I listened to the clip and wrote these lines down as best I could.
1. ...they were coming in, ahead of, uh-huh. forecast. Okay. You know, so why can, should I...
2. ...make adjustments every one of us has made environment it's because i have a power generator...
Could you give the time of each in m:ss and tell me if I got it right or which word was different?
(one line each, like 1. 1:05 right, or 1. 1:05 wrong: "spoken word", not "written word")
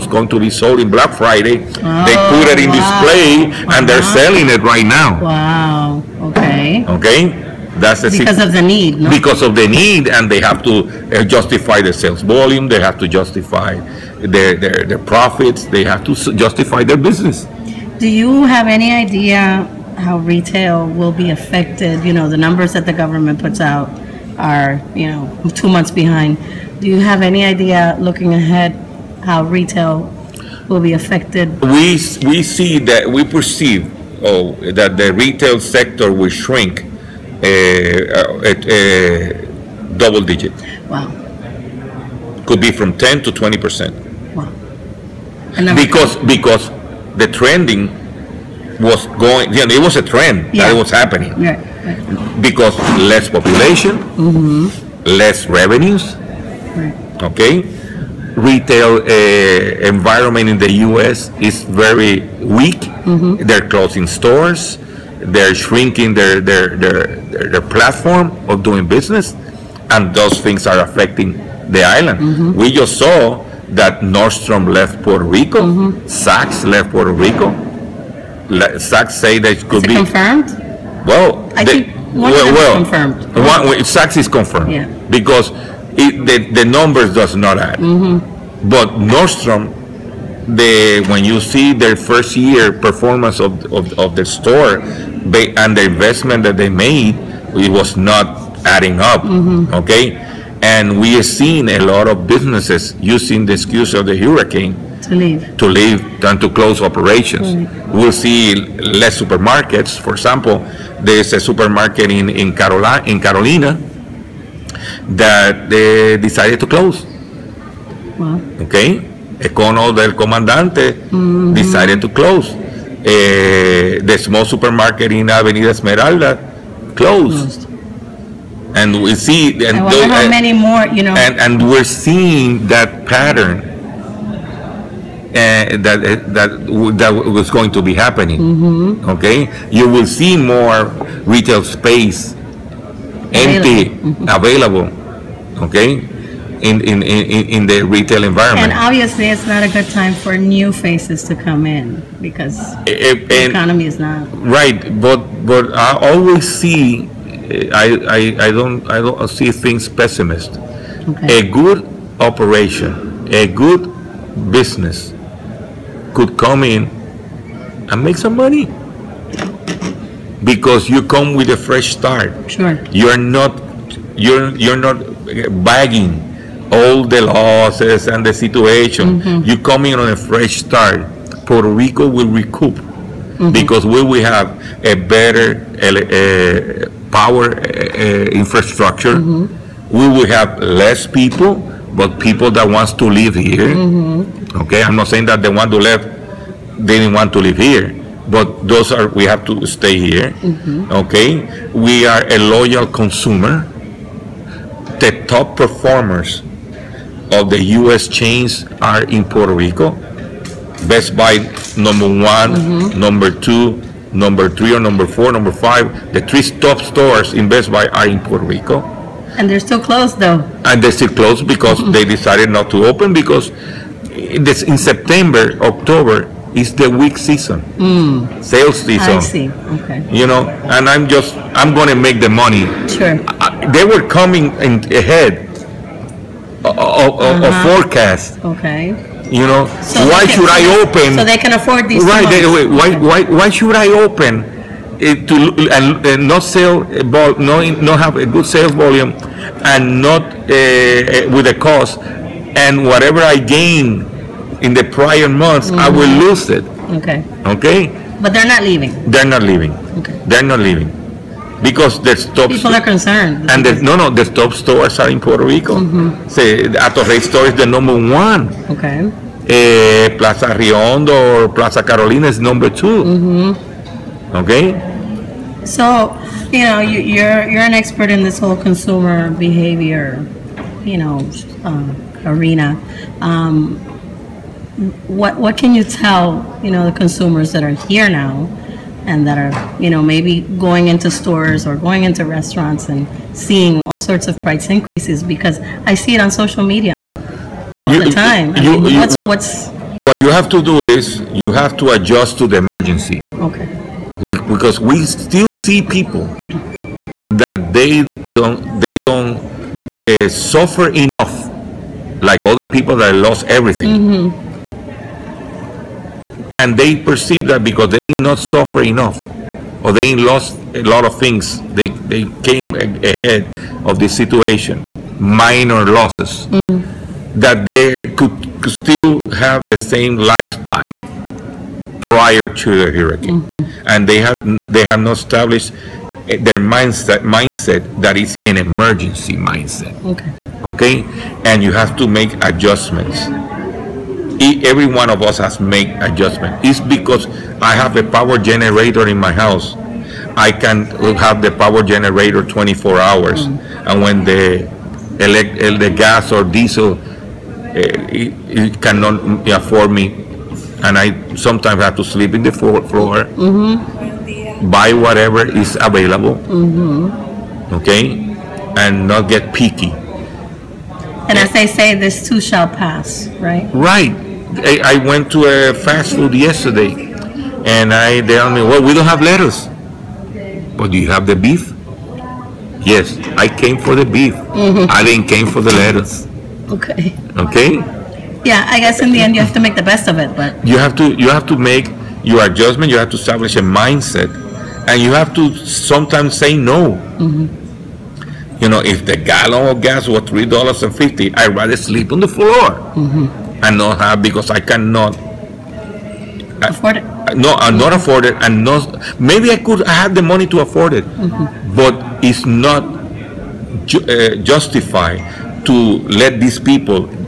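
1. 3:53 right
2. 5:42 wrong: "adjustment", not "environment".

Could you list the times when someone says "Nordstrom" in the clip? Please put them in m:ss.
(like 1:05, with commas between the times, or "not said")
1:14, 1:28.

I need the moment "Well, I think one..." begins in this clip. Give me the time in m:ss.
1:21.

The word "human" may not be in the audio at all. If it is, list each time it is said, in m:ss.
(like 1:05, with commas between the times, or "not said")
not said.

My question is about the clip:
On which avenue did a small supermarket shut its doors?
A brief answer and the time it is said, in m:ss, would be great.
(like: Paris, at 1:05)
Avenida Esmeralda, at 2:05.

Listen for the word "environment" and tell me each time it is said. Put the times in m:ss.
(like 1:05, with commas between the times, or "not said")
0:59, 2:28.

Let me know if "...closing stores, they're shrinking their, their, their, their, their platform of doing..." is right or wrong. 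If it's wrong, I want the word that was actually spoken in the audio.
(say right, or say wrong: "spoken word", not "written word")
right.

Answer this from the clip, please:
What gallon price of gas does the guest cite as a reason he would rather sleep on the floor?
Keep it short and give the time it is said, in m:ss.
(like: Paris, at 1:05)
$3.50, at 6:40.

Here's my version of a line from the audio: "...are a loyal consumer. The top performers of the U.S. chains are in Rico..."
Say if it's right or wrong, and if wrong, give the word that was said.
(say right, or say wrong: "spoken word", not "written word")
wrong: "Puerto", not "Rico".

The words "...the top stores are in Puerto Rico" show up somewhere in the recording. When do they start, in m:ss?
4:24.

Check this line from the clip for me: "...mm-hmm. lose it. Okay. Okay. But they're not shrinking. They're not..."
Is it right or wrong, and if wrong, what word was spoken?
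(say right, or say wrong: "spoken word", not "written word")
wrong: "leaving", not "shrinking".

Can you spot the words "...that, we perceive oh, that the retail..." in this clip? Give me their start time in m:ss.
0:32.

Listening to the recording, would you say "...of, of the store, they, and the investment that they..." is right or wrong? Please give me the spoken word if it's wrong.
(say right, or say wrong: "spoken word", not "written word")
right.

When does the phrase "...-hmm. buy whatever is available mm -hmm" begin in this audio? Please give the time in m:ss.
6:03.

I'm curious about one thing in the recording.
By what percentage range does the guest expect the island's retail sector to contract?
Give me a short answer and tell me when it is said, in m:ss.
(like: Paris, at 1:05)
10 to 20 percent, at 0:42.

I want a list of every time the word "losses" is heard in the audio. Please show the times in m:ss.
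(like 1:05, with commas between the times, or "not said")
2:57, 5:25.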